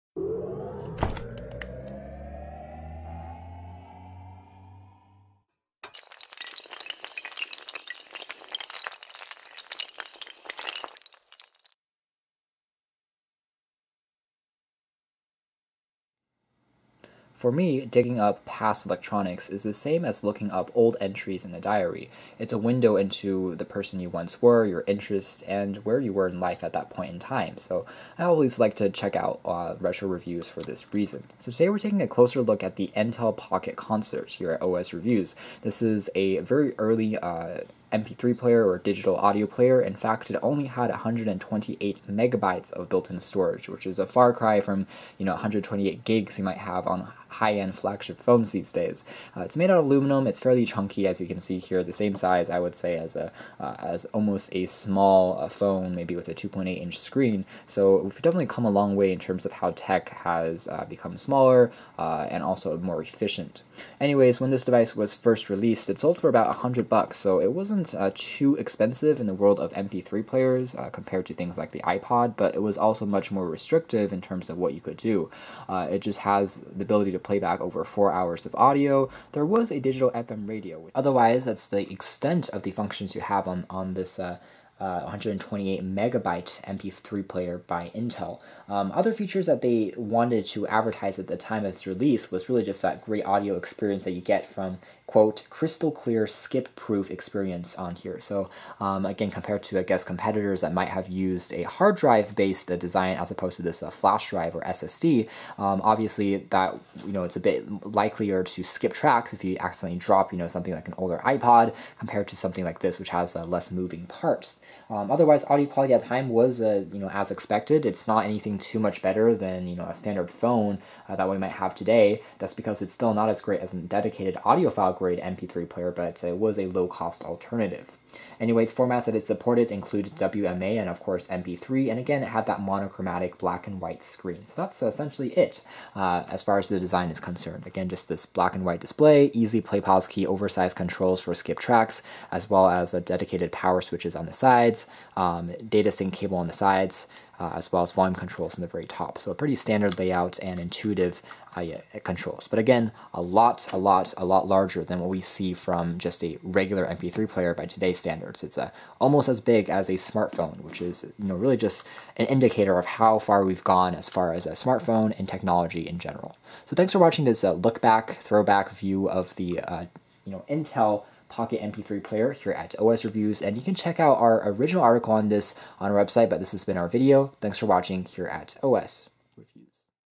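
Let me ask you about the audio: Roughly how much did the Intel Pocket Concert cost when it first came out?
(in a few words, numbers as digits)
$100.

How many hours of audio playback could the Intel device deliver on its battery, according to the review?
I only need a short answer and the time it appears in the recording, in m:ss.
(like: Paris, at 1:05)
over 4 hours, at 1:17.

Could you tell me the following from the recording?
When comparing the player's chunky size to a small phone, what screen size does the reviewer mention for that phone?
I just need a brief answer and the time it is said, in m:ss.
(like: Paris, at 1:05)
2.8-inch, at 0:56.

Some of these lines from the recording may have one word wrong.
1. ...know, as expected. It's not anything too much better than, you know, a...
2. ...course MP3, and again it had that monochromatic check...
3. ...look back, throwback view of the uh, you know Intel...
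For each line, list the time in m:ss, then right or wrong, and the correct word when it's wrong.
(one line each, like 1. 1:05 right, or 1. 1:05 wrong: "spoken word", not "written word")
1. 1:56 right
2. 2:10 wrong: "black", not "check"
3. 2:47 right.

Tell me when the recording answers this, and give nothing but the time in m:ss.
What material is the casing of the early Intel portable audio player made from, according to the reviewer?
0:49.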